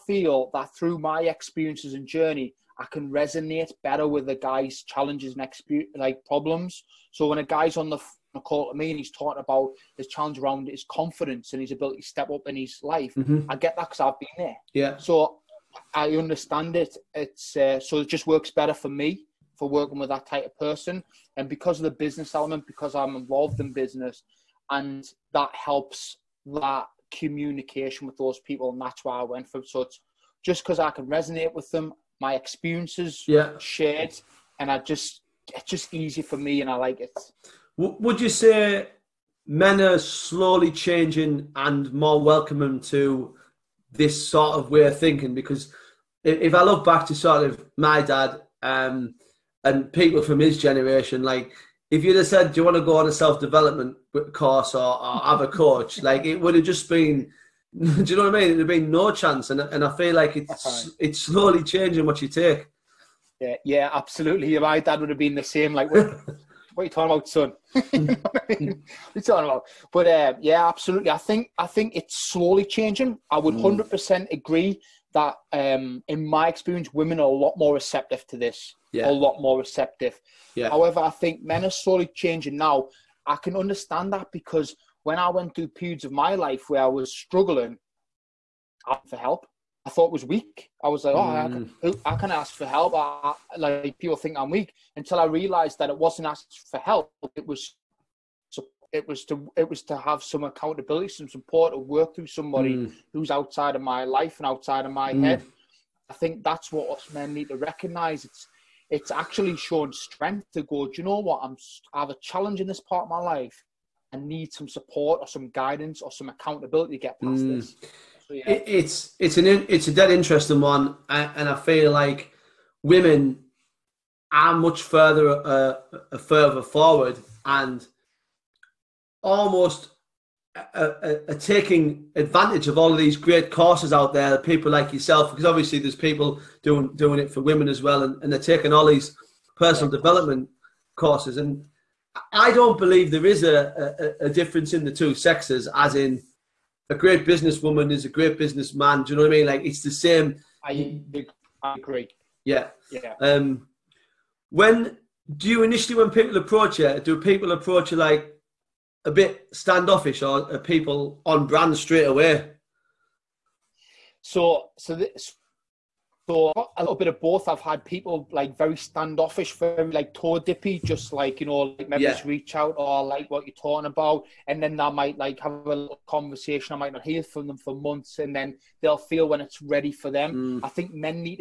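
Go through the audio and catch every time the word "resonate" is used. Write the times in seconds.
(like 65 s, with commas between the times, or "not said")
3 s, 31 s.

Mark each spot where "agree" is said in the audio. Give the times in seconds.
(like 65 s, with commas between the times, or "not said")
74 s, 151 s.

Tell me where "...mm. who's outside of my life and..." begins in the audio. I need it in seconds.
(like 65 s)
102 s.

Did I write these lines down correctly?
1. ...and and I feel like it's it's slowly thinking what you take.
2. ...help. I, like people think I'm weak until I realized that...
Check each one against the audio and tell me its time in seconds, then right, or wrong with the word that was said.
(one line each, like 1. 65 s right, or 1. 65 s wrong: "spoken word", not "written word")
1. 59 s wrong: "changing", not "thinking"
2. 92 s right.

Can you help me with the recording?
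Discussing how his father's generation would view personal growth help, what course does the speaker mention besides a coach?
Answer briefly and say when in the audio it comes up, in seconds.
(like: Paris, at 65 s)
Self-development course, at 53 s.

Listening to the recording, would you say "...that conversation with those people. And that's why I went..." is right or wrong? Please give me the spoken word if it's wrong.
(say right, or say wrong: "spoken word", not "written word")
wrong: "communication", not "conversation".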